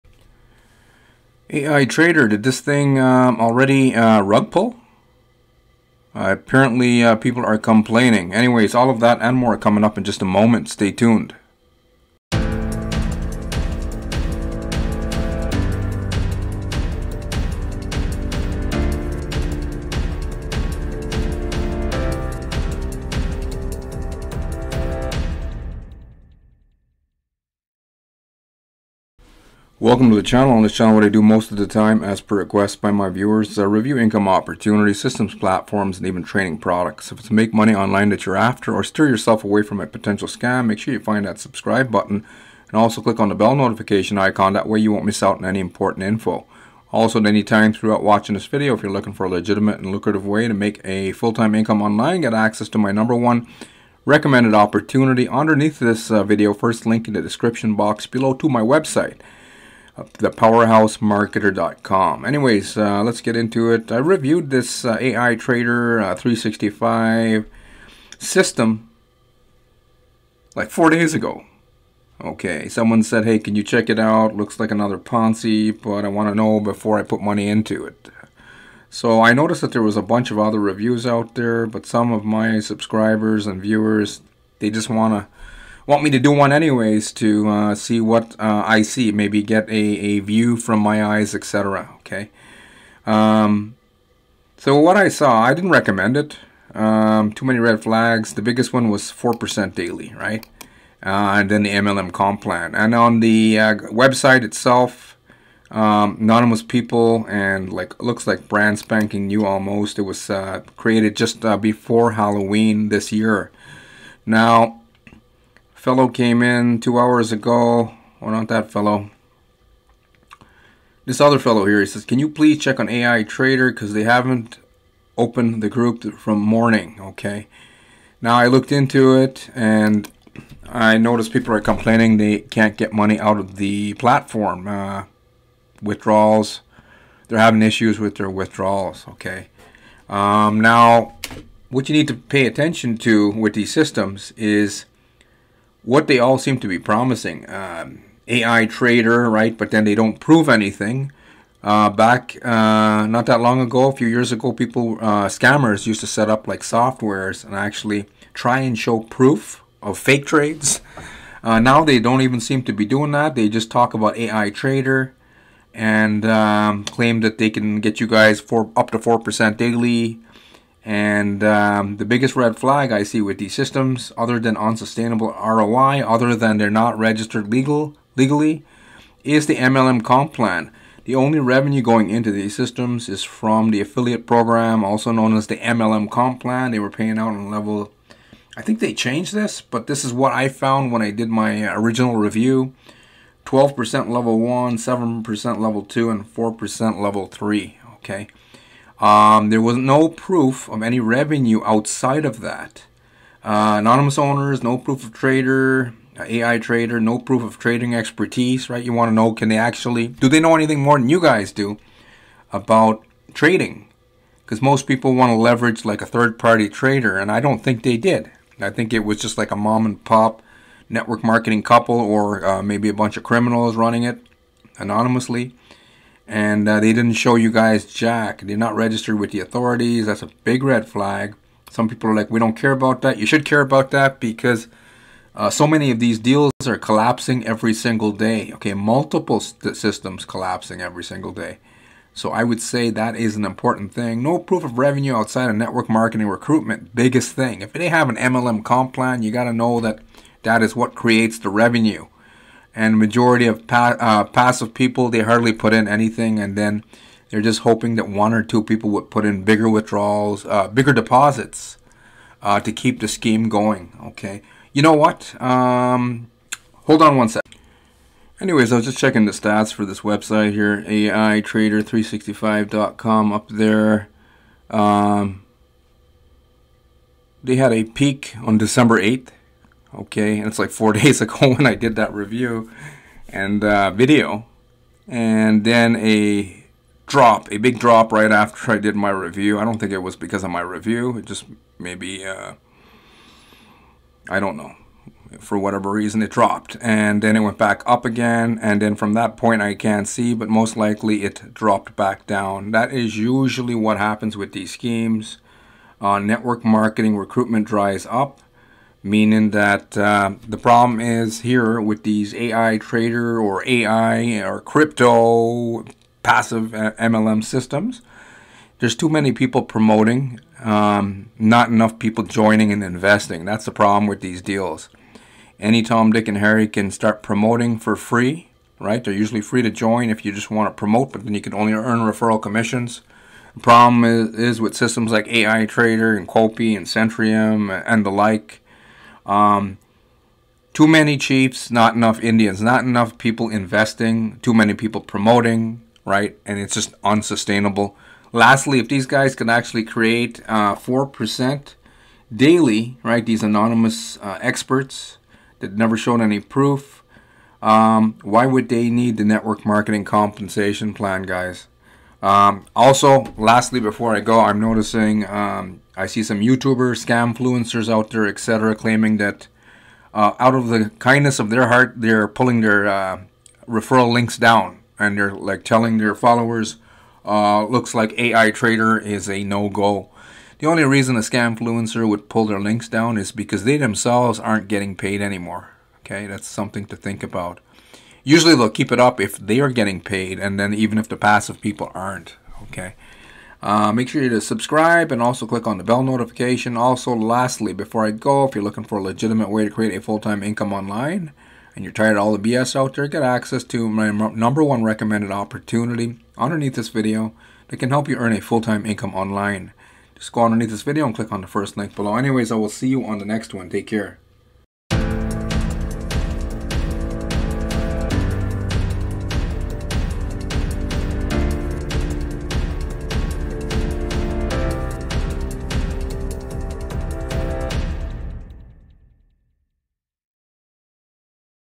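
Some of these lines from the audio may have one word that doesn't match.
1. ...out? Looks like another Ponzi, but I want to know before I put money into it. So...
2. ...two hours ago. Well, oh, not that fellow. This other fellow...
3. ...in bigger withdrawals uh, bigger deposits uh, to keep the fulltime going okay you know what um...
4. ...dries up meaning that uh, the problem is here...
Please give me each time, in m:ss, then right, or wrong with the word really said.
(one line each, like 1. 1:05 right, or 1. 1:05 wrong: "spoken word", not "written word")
1. 1:13 right
2. 1:56 right
3. 4:19 wrong: "scheme", not "fulltime"
4. 5:07 right.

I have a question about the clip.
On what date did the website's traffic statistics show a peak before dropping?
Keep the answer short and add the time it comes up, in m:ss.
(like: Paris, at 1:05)
December 8, at 4:38.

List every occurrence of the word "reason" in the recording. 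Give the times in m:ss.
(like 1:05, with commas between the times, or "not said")
4:55, 6:20.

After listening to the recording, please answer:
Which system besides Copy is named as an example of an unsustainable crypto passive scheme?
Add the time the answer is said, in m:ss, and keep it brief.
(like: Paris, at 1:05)
Centrium, at 5:36.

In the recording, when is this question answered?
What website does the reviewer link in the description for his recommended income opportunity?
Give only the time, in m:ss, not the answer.
0:59.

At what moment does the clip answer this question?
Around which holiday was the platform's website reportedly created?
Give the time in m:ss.
1:52.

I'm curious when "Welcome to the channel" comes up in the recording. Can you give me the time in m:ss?
0:29.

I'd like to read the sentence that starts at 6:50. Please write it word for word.
Just go underneath this video and click on the first link below.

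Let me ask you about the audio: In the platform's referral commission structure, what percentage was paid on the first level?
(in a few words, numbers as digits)
12%.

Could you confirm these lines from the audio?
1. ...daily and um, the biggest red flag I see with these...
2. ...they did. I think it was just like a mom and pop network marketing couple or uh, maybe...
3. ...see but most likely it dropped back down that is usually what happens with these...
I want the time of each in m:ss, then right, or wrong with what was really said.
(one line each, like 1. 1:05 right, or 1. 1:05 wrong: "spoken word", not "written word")
1. 2:49 right
2. 3:37 right
3. 5:00 right.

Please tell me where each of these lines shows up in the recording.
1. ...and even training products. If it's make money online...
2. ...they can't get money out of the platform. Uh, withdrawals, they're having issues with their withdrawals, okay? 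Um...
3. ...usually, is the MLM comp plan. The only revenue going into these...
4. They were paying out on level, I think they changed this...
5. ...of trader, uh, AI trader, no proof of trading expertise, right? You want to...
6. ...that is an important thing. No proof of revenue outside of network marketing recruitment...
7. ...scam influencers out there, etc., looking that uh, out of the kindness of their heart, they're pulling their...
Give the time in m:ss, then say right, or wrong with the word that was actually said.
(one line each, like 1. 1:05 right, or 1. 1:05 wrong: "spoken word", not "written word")
1. 0:35 right
2. 2:12 right
3. 2:58 wrong: "legally", not "usually"
4. 3:06 right
5. 3:25 right
6. 4:02 right
7. 6:07 wrong: "claiming", not "looking".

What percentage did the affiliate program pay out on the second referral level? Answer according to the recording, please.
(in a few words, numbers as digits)
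7%.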